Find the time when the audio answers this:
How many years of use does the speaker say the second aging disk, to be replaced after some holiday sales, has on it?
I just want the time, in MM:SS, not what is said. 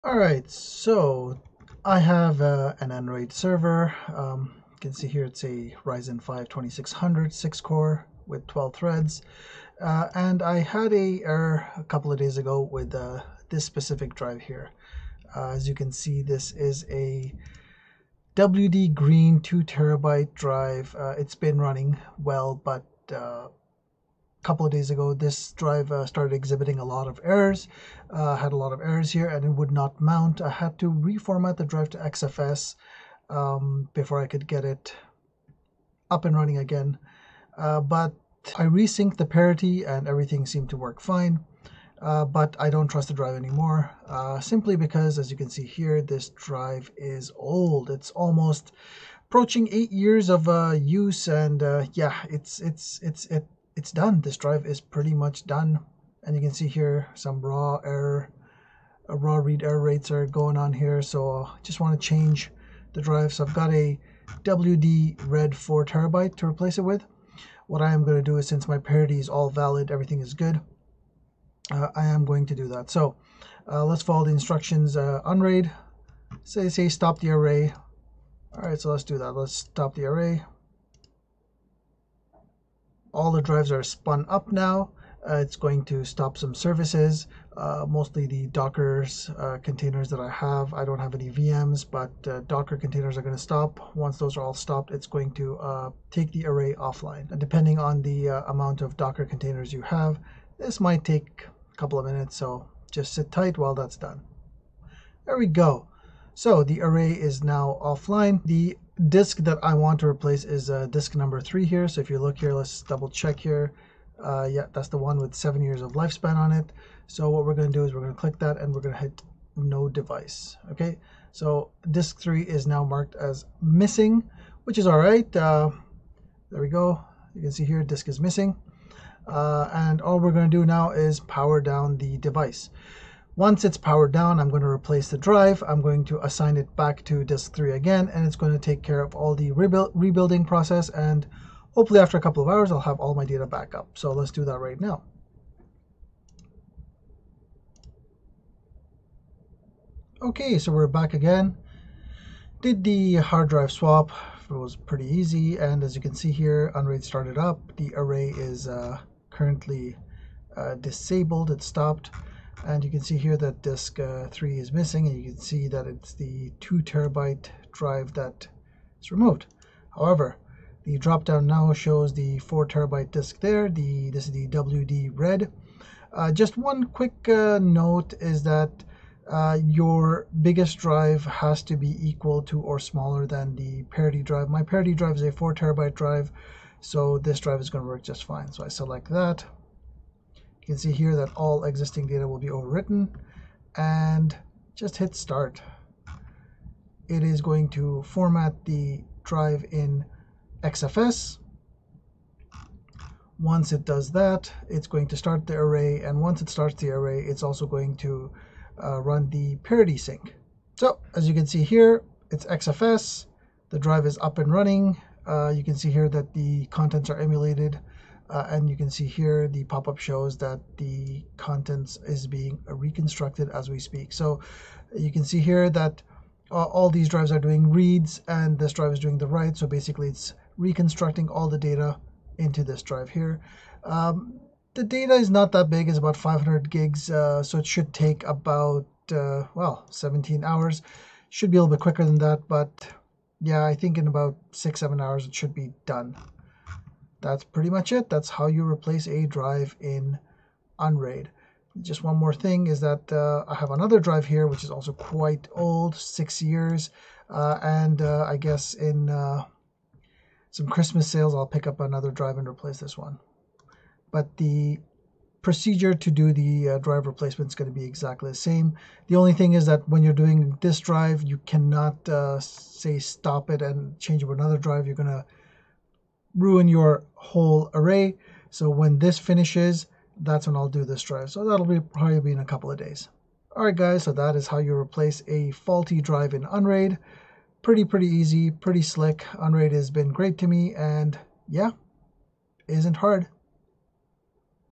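04:15.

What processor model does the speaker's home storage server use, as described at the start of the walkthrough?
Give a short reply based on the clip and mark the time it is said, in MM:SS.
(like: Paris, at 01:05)
Ryzen 5 2600, at 00:05.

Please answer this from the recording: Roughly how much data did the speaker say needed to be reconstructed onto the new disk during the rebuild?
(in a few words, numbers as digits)
500 gigs.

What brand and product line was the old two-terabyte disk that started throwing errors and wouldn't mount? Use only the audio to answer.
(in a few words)
WD Green.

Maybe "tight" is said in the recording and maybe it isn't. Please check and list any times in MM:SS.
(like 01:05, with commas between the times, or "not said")
01:43.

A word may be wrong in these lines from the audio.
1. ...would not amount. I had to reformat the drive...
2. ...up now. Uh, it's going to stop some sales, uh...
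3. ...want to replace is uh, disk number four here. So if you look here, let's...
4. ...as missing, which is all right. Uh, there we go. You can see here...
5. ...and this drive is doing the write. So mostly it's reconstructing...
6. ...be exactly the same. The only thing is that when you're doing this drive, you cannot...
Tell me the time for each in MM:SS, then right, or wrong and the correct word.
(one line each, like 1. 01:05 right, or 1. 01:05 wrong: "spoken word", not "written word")
1. 00:29 wrong: "mount", not "amount"
2. 01:24 wrong: "services", not "sales"
3. 01:49 wrong: "three", not "four"
4. 02:03 right
5. 03:48 wrong: "basically", not "mostly"
6. 04:27 right.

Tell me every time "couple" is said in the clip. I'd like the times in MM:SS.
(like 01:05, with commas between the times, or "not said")
00:11, 00:24, 01:41, 02:22, 04:42.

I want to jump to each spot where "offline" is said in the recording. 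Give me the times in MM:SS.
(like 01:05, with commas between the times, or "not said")
01:36, 01:47.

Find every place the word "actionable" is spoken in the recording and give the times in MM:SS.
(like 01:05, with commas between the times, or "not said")
not said.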